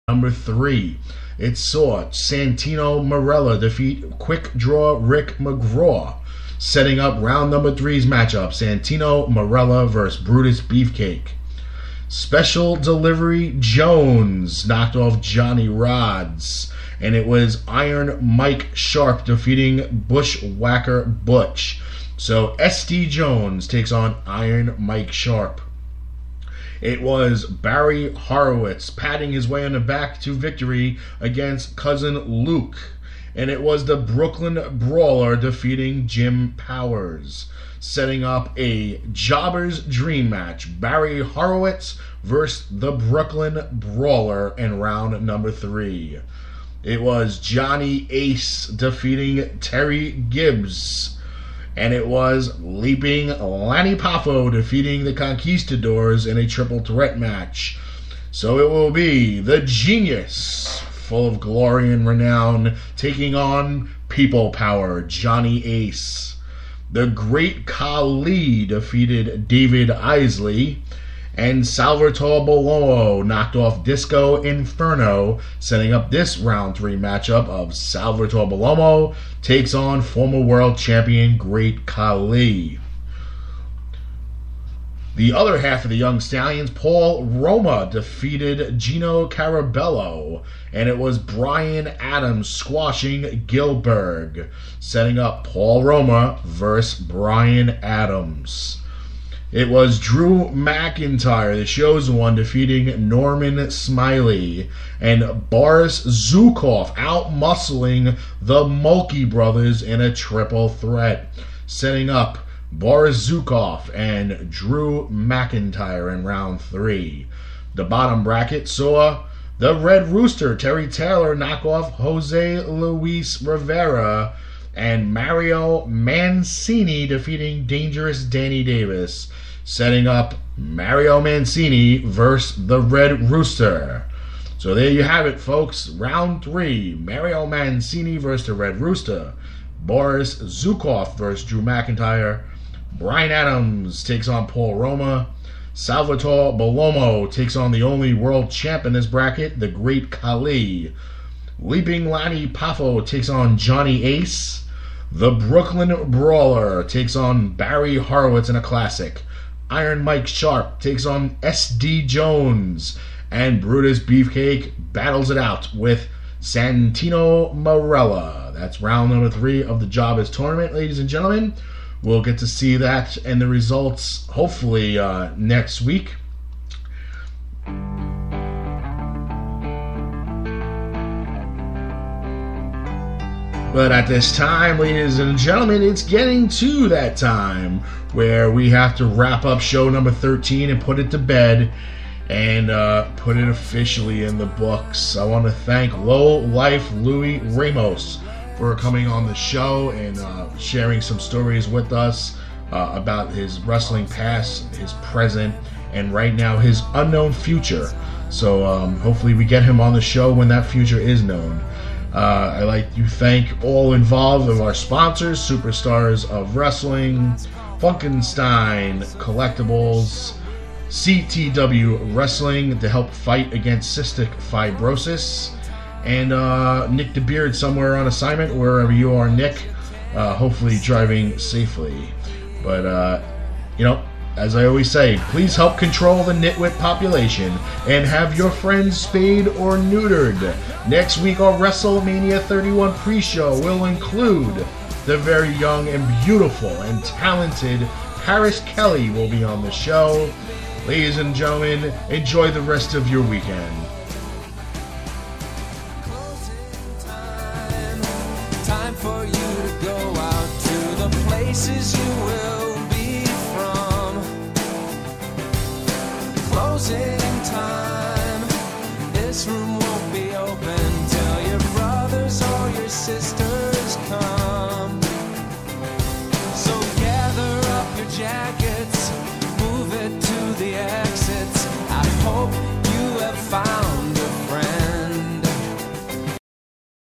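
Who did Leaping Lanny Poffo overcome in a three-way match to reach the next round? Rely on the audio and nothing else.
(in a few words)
The Conquistadors.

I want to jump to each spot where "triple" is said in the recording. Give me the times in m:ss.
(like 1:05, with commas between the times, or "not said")
0:56, 1:50.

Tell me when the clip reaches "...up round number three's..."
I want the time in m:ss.
0:06.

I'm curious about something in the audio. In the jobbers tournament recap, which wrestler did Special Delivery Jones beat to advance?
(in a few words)
Johnny Rodz.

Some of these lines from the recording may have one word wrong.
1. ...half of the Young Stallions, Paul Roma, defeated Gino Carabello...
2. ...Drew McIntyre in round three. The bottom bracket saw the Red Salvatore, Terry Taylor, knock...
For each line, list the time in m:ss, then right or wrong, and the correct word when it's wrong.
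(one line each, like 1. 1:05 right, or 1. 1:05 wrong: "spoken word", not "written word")
1. 1:25 right
2. 1:54 wrong: "Rooster", not "Salvatore".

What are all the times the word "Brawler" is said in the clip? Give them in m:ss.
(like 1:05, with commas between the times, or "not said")
0:34, 0:43, 2:36.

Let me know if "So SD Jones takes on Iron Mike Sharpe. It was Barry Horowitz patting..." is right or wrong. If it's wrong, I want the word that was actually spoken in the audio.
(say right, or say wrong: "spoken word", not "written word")
right.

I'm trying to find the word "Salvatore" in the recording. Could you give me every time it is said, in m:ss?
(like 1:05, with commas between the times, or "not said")
1:11, 1:17, 2:25.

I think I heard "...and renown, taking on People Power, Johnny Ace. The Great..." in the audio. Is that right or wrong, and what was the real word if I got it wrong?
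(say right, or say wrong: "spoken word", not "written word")
right.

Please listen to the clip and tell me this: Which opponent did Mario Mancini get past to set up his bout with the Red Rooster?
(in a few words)
Dangerous Danny Davis.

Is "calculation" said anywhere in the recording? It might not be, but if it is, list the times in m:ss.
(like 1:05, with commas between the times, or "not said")
not said.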